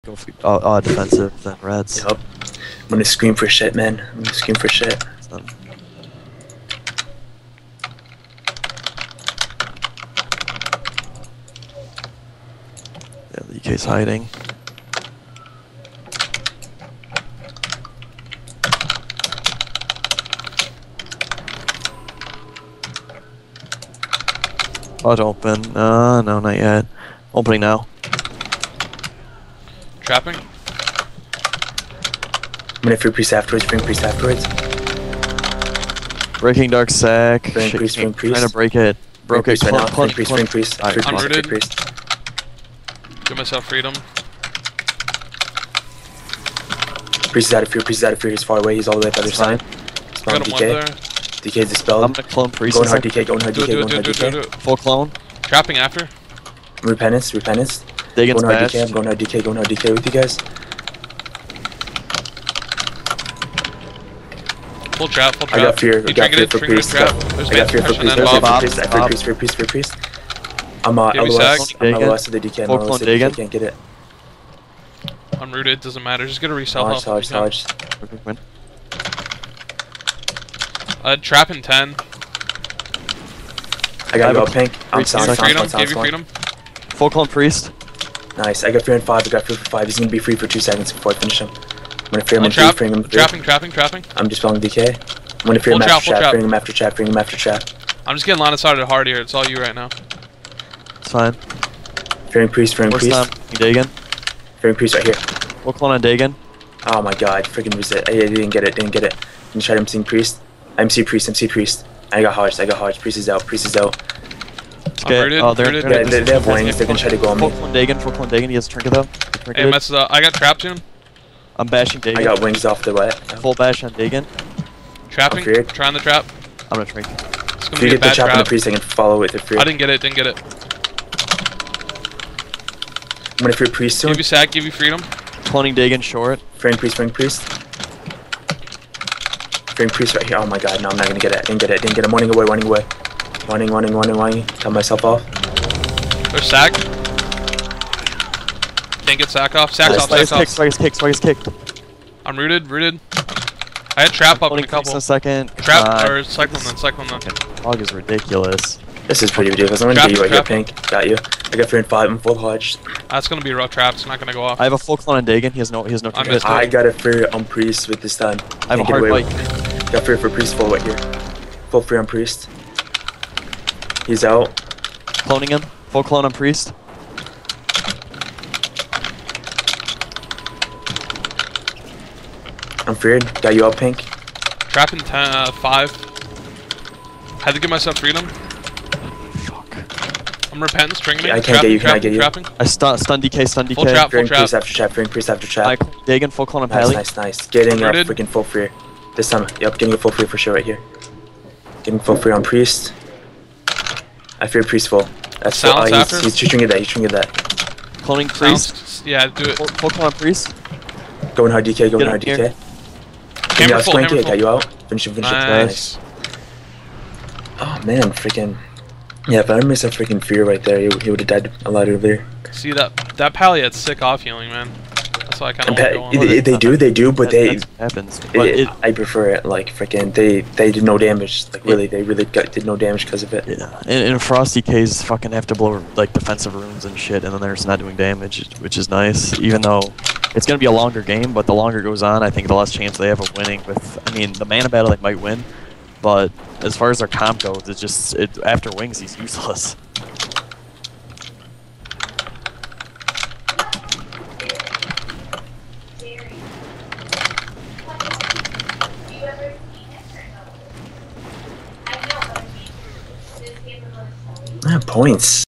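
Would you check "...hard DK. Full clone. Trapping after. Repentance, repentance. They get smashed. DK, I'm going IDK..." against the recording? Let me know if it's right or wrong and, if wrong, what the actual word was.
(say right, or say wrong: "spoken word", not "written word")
right.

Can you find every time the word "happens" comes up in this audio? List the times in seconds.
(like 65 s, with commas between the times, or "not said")
227 s.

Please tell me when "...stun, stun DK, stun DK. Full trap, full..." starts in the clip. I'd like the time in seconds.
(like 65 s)
192 s.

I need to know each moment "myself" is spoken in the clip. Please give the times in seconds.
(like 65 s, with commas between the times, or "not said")
43 s, 144 s, 187 s.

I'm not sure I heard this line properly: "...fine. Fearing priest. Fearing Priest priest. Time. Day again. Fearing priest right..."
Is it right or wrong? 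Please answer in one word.
wrong.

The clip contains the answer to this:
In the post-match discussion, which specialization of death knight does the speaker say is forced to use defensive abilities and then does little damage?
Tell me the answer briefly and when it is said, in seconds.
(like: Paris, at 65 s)
Frost, at 234 s.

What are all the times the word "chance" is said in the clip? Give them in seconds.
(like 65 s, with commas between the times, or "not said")
242 s.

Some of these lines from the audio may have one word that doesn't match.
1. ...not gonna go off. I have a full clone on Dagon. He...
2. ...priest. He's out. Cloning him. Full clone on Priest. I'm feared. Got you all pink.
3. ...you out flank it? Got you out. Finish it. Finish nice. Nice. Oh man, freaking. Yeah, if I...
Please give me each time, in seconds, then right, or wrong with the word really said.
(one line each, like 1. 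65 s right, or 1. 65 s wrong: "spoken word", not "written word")
1. 164 s right
2. 172 s right
3. 213 s right.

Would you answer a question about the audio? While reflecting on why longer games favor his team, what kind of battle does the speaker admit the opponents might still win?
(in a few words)
mana battle.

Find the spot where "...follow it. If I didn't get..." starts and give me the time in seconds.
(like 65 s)
128 s.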